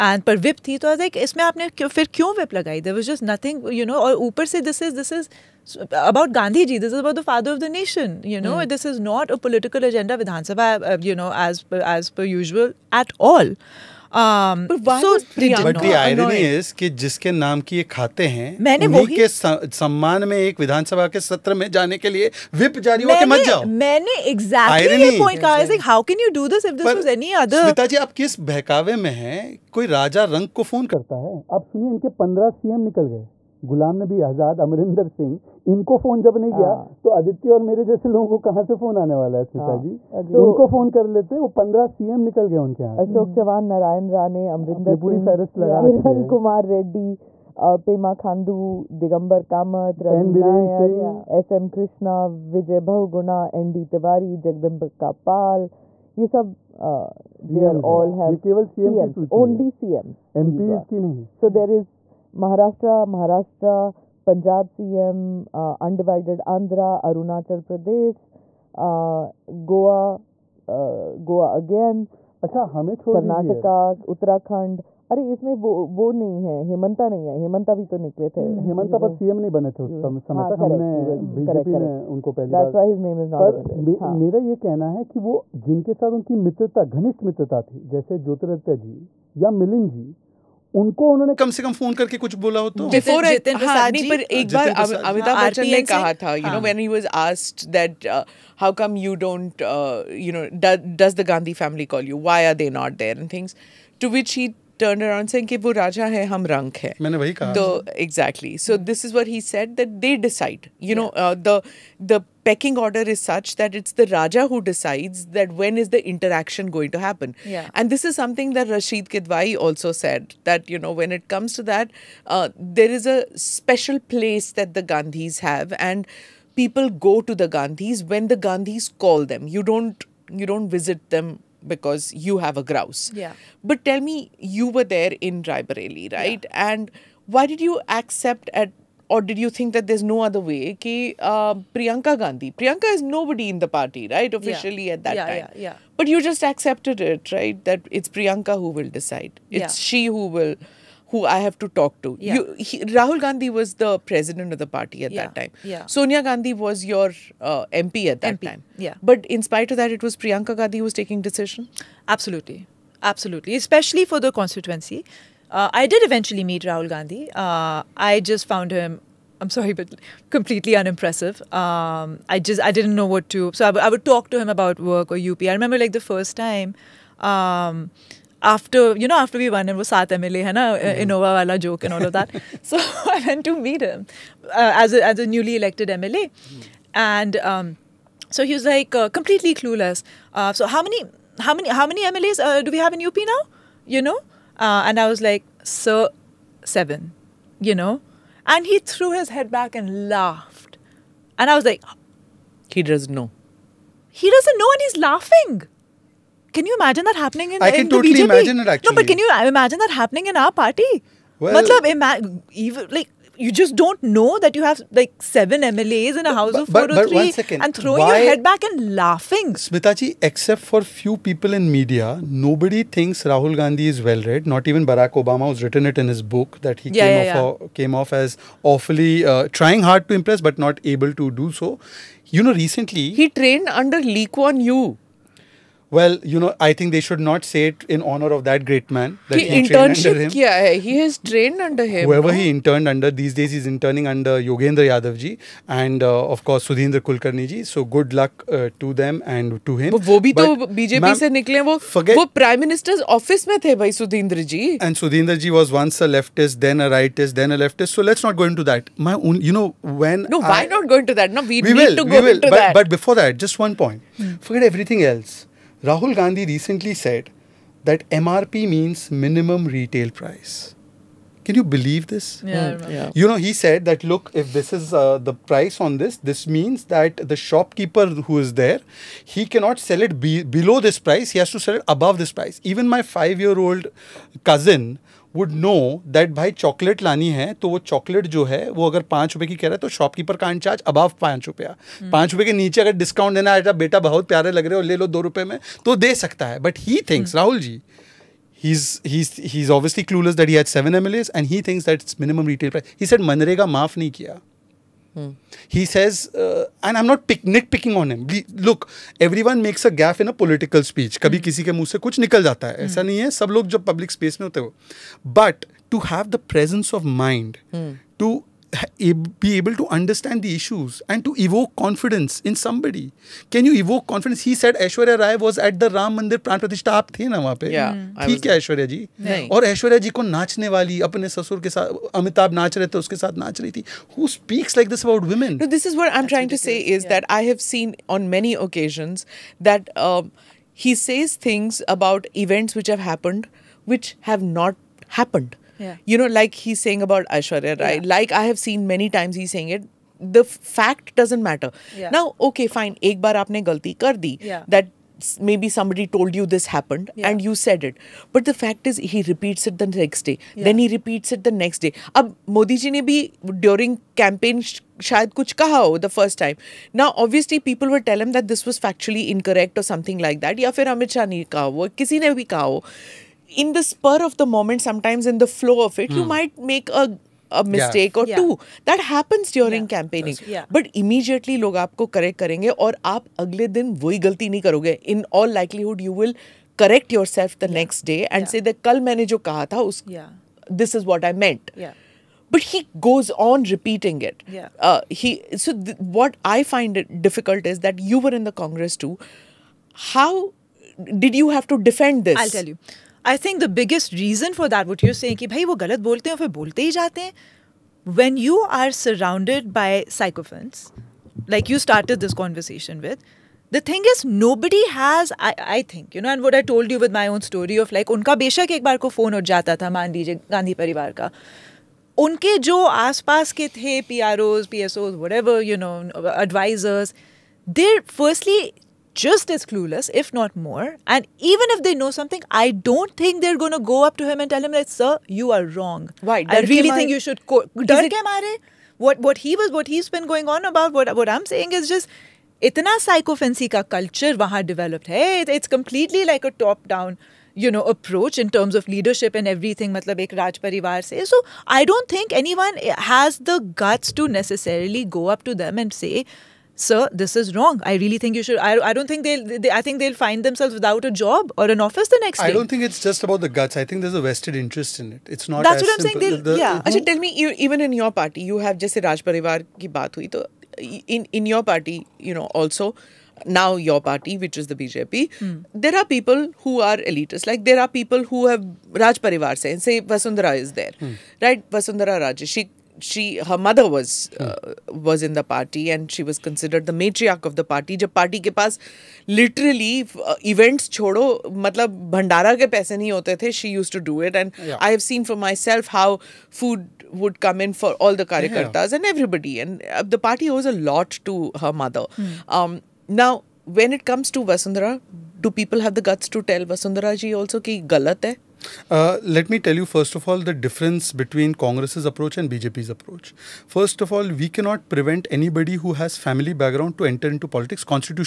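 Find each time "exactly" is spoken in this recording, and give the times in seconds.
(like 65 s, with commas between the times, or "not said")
108 s.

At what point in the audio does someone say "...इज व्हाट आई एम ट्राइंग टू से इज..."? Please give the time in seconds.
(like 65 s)
335 s.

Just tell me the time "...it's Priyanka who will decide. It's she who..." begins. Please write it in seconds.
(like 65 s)
147 s.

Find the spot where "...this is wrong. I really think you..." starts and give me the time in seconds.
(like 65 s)
457 s.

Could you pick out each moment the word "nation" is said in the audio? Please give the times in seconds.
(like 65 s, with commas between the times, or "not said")
7 s.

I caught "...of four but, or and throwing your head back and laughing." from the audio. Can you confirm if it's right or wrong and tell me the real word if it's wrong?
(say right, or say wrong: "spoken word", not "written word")
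right.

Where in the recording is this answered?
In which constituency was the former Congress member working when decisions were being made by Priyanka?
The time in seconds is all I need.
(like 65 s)
135 s.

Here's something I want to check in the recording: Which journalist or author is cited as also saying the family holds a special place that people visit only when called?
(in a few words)
Rashid Kidwai.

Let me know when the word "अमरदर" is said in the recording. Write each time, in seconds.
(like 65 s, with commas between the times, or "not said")
34 s, 44 s.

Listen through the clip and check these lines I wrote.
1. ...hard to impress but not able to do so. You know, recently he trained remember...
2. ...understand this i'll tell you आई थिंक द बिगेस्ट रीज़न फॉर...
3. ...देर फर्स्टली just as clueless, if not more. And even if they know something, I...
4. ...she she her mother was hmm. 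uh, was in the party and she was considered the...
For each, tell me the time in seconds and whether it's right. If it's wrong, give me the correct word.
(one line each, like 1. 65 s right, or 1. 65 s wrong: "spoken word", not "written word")
1. 229 s wrong: "under", not "remember"
2. 401 s wrong: "defend", not "understand"
3. 427 s right
4. 482 s right.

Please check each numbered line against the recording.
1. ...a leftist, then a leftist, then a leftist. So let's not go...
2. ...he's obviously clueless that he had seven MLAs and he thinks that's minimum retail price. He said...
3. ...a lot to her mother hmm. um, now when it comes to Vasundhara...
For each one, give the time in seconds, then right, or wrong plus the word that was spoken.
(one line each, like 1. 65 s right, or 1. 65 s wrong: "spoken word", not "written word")
1. 256 s wrong: "rightist", not "leftist"
2. 299 s right
3. 500 s right.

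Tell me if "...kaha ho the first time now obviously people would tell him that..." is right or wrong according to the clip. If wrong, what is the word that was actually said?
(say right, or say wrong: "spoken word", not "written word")
right.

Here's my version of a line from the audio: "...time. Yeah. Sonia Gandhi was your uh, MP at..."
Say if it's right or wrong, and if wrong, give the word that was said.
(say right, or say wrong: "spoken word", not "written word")
right.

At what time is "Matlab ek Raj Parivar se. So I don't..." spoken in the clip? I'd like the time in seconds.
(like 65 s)
449 s.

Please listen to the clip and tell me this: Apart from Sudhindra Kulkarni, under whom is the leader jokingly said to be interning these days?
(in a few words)
Yogendra Yadav.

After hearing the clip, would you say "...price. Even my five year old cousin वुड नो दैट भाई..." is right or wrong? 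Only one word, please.
right.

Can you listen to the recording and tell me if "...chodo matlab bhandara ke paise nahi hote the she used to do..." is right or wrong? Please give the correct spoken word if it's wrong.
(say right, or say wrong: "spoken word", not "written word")
right.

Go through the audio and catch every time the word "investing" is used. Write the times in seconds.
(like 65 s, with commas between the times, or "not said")
not said.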